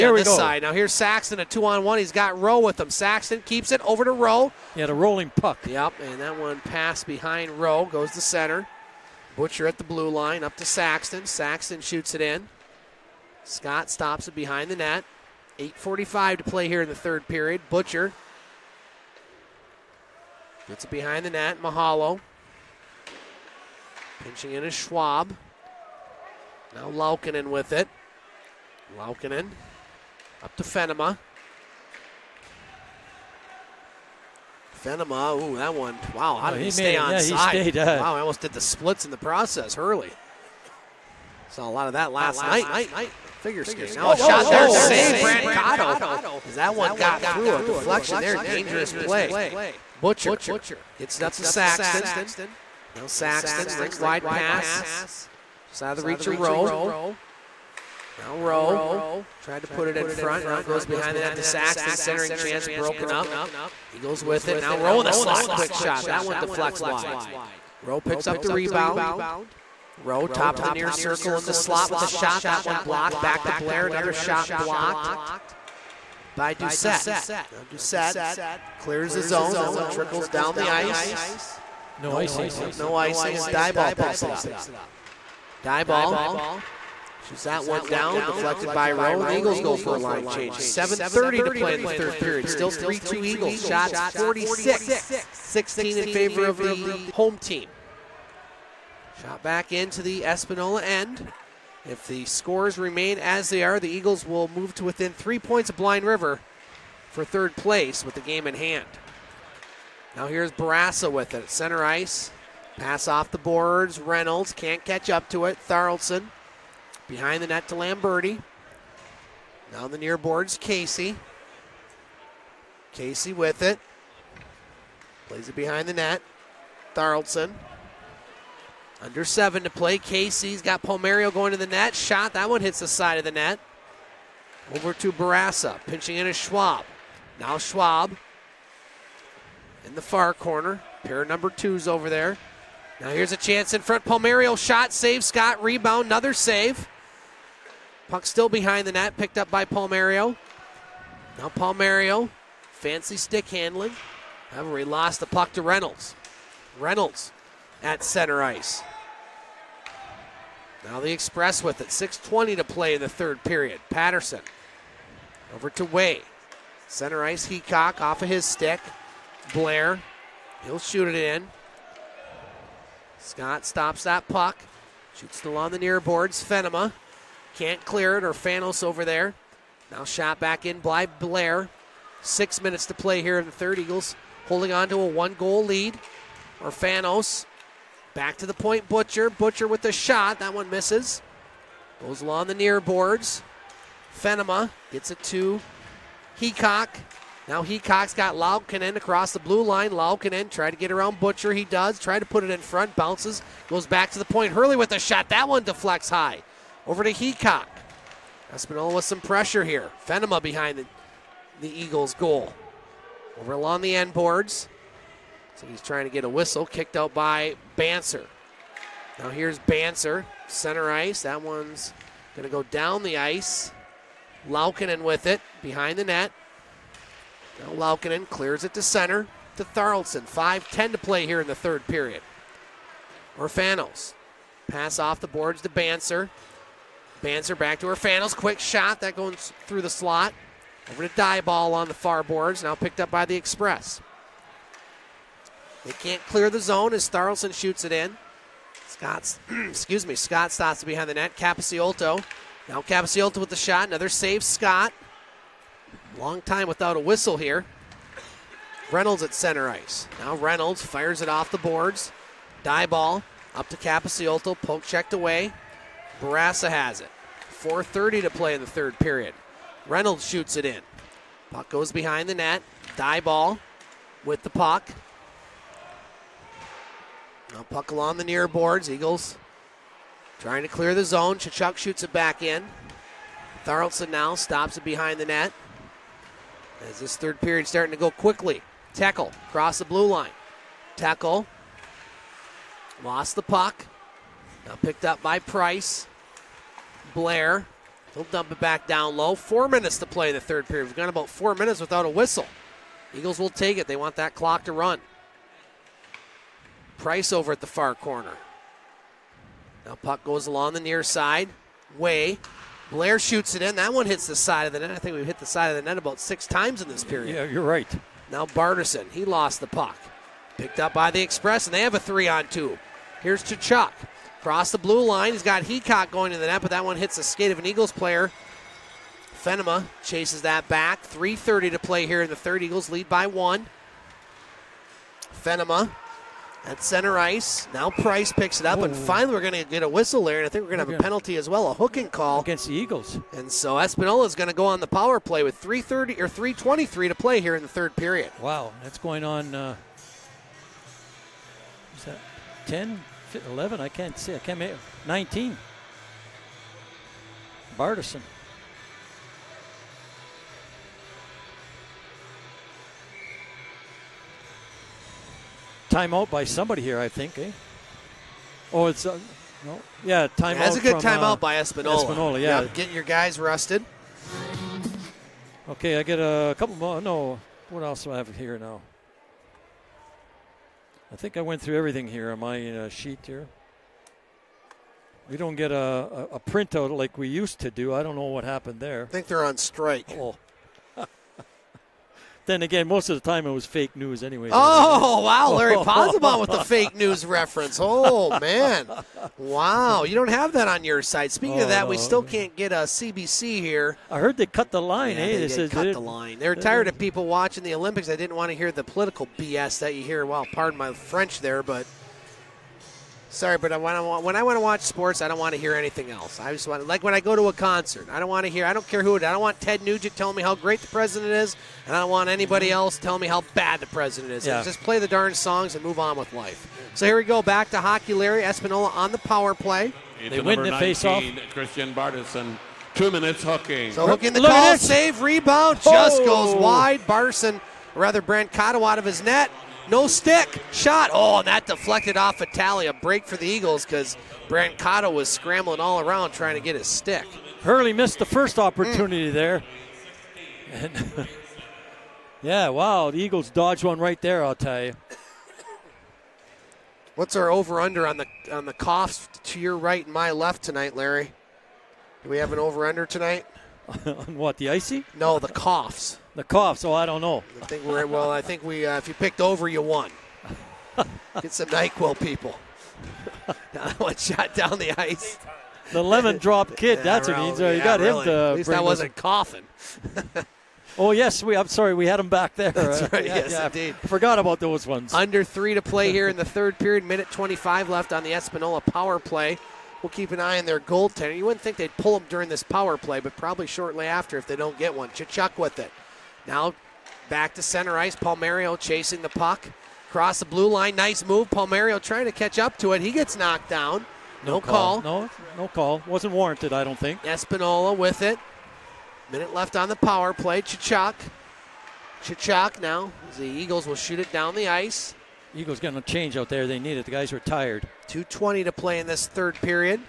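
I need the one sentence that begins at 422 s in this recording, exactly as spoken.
else telling me how bad the president is.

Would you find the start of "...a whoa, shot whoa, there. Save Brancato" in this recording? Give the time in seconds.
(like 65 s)
44 s.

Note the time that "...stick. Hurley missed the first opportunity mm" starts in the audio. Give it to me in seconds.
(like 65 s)
446 s.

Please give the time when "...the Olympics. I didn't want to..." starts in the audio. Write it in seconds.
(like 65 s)
407 s.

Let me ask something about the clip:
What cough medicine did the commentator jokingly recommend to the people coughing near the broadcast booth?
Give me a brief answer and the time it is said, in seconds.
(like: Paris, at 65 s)
Nyquil, at 471 s.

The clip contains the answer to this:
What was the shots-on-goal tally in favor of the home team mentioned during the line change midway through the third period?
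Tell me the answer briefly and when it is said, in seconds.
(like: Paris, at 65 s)
46-16, at 94 s.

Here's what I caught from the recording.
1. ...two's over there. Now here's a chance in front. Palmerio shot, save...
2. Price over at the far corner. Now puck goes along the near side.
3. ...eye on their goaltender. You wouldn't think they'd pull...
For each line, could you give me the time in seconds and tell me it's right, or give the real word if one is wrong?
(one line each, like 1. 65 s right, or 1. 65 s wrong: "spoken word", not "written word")
1. 141 s right
2. 306 s right
3. 490 s right.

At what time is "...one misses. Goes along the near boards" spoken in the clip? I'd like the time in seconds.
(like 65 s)
190 s.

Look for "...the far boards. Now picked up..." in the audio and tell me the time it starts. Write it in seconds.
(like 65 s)
241 s.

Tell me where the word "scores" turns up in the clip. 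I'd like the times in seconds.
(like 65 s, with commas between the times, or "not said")
102 s.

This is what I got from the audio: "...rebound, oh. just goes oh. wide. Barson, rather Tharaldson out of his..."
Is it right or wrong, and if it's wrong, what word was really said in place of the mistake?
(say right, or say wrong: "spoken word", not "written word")
wrong: "Brancato", not "Tharaldson".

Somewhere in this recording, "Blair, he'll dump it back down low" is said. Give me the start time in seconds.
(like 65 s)
297 s.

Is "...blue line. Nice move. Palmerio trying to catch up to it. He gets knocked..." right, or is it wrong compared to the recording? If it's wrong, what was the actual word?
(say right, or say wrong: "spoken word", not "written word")
right.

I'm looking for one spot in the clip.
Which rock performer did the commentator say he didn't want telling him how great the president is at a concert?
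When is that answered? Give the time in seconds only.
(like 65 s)
419 s.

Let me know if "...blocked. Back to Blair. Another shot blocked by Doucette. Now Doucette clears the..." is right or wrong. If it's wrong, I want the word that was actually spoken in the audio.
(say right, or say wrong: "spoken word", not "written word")
right.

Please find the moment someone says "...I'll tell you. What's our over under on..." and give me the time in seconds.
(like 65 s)
454 s.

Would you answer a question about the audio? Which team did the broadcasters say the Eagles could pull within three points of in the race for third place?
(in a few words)
Blind River.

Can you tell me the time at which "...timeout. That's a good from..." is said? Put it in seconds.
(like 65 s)
370 s.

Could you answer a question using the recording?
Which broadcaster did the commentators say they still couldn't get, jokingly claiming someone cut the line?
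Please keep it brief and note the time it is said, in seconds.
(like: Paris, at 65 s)
CBC, at 402 s.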